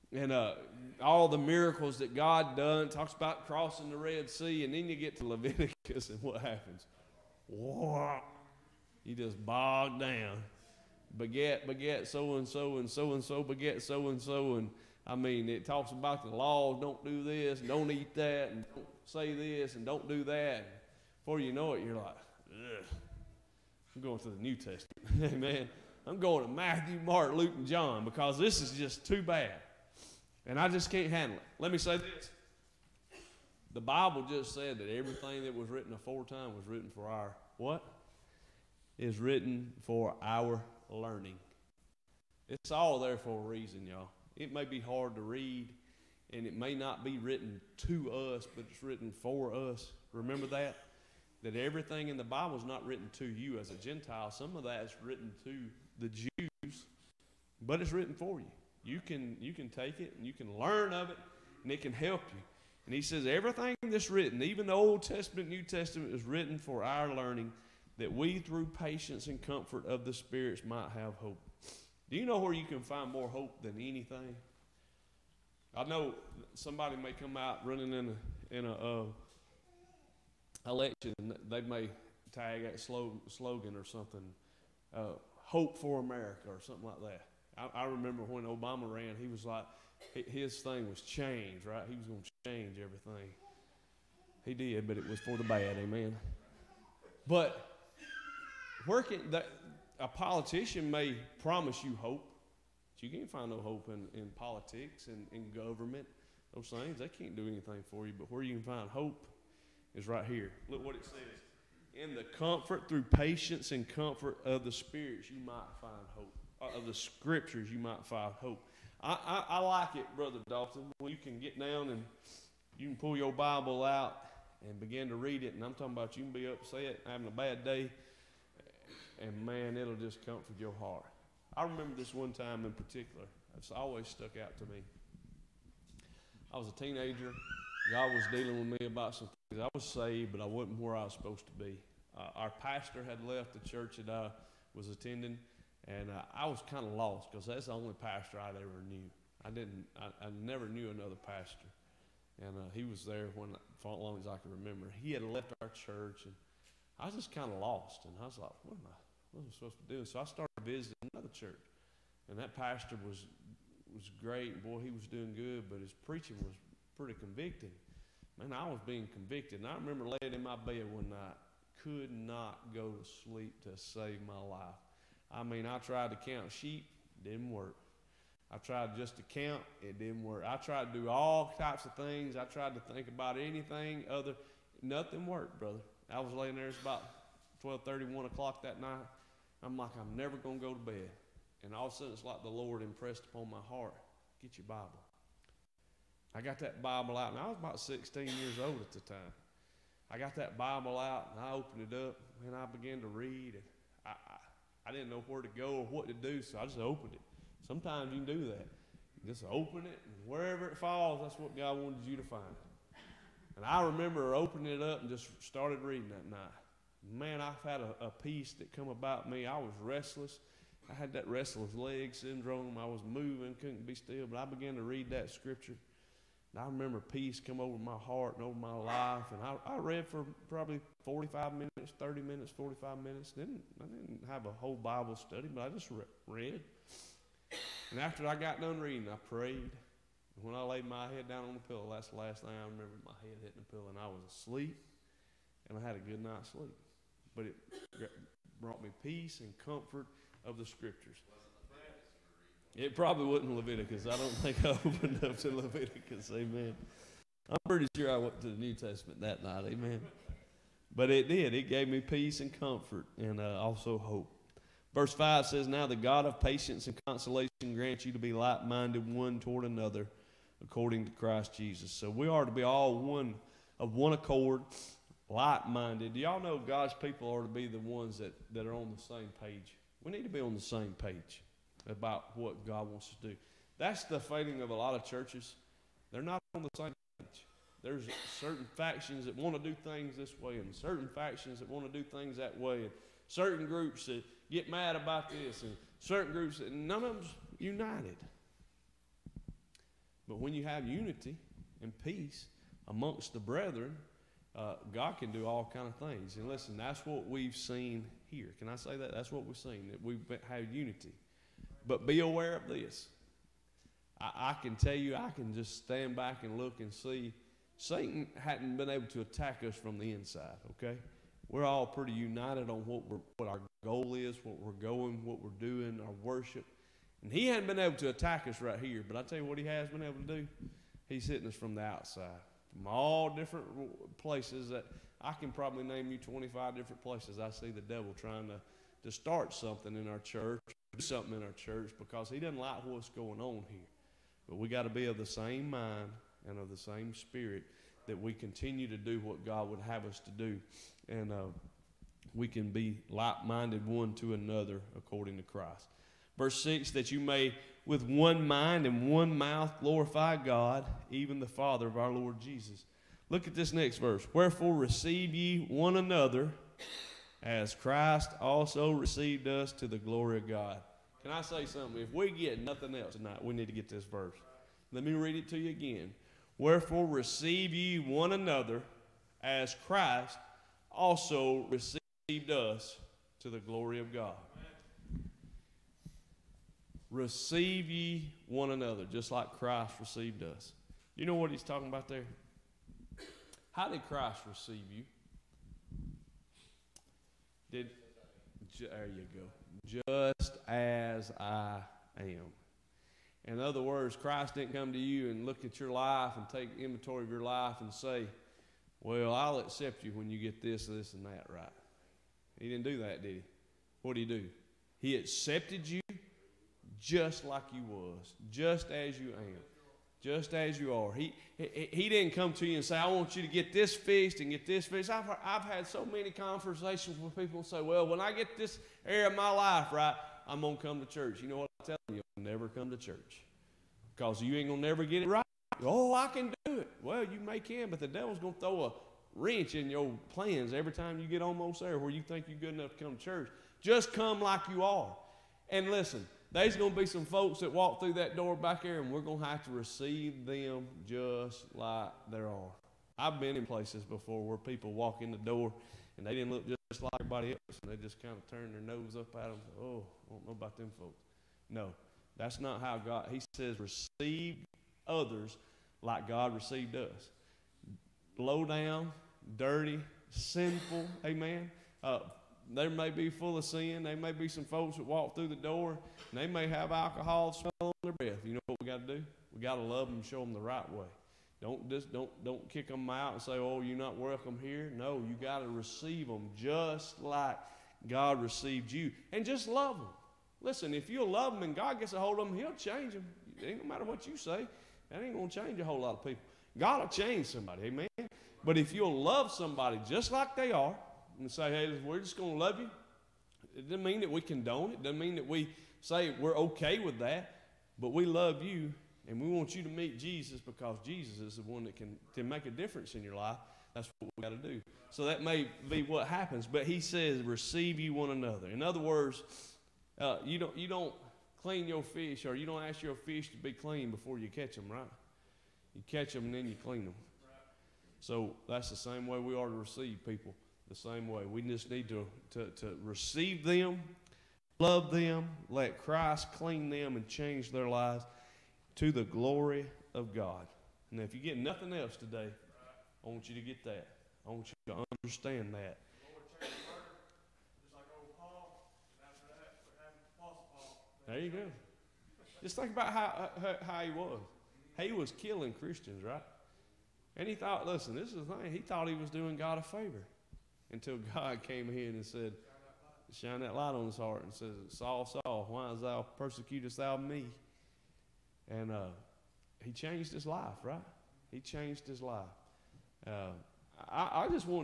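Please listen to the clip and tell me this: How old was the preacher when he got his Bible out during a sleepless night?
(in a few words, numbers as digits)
16.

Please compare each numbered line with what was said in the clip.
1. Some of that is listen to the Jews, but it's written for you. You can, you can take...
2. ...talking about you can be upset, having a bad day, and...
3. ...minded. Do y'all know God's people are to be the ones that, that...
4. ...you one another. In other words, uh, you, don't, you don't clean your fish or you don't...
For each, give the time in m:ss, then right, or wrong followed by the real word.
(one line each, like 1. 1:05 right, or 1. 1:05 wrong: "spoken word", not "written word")
1. 0:54 wrong: "written", not "listen"
2. 2:05 right
3. 4:35 right
4. 8:37 right.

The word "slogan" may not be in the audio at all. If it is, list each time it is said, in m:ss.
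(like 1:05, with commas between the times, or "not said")
1:22.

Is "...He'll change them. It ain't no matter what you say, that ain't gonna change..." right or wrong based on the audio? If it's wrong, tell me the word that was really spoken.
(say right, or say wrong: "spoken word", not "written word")
right.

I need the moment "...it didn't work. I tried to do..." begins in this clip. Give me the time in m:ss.
2:59.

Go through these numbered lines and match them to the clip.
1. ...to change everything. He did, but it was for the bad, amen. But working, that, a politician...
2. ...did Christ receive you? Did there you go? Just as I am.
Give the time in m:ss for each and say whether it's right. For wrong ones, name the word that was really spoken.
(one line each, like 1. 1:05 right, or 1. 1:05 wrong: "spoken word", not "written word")
1. 1:32 right
2. 6:33 right.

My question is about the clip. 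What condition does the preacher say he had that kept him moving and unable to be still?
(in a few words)
restless leg syndrome.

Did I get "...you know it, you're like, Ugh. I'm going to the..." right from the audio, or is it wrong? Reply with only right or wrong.
right.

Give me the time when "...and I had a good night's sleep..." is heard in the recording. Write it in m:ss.
4:05.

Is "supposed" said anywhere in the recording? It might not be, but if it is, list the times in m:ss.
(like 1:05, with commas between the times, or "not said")
2:21, 2:39.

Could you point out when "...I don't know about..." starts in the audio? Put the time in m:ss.
7:40.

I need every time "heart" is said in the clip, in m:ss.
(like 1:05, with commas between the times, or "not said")
2:10, 3:13, 3:47, 9:24.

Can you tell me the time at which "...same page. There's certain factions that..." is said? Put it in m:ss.
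4:46.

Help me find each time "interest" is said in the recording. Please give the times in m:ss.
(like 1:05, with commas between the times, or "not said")
not said.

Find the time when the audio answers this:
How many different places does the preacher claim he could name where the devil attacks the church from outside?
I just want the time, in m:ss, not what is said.
5:36.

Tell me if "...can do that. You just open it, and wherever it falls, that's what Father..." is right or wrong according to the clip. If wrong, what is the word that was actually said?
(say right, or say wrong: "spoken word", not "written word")
wrong: "God", not "Father".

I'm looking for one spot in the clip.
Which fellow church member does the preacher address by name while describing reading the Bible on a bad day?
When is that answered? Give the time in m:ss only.
2:00.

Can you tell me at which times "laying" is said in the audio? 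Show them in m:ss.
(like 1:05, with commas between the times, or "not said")
2:50, 3:06.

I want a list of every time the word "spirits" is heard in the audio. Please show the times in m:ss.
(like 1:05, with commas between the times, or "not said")
1:10, 1:54, 5:47.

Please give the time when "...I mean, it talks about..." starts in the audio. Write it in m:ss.
0:15.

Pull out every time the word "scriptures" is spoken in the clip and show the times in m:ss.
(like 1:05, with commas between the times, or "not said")
1:56, 3:45, 4:10.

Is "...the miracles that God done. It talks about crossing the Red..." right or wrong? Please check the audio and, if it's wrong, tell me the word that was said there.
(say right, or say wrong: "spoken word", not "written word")
right.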